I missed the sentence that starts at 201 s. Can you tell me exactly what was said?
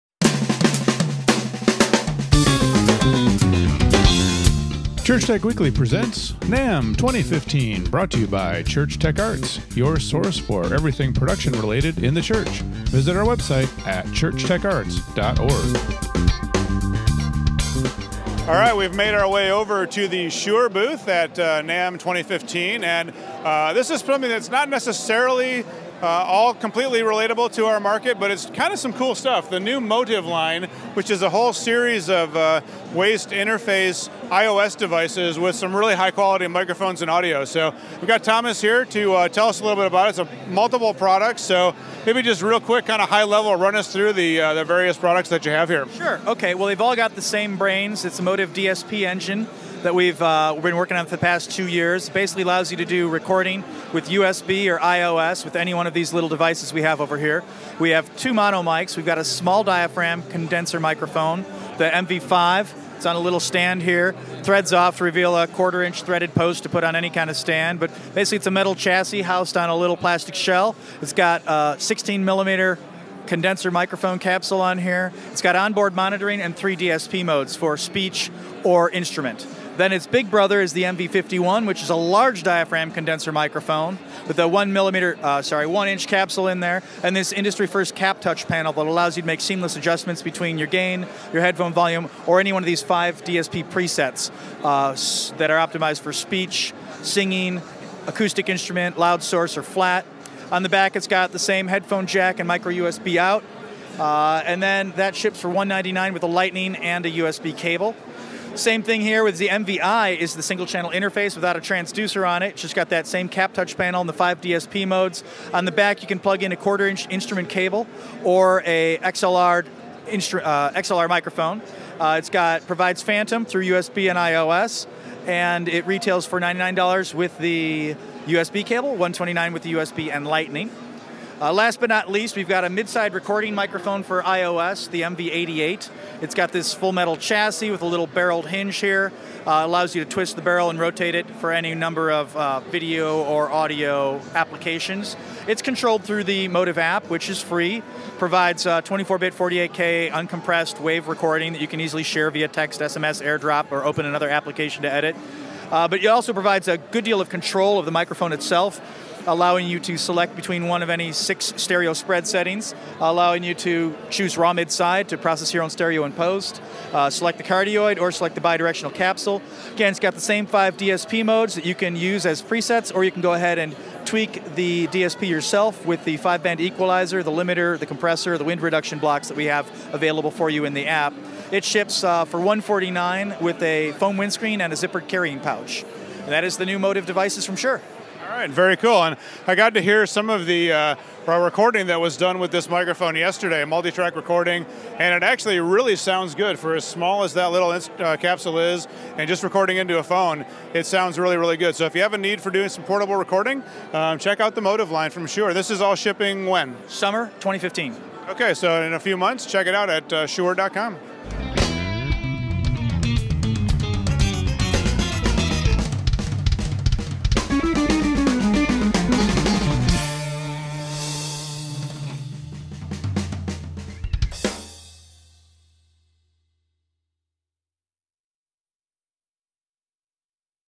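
So if you have a need for doing some portable recording, um, check out the Motiv line from Shure.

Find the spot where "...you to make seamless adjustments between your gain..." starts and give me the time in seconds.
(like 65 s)
89 s.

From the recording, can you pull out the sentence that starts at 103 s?
Uh, and then that ships for 199 with a lightning and a USB cable.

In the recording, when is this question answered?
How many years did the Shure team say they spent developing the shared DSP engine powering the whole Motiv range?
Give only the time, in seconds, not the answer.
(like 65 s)
51 s.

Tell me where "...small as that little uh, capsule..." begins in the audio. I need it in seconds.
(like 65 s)
196 s.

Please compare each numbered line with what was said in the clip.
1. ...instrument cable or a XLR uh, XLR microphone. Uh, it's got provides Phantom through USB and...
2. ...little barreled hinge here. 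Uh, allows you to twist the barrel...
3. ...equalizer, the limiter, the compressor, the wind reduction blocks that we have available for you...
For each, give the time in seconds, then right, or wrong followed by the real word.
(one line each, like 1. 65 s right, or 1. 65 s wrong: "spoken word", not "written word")
1. 117 s right
2. 137 s right
3. 176 s right.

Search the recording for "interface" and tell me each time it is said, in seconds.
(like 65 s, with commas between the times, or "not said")
33 s, 110 s.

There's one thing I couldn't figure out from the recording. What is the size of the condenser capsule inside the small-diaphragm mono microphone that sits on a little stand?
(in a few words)
16 millimeter.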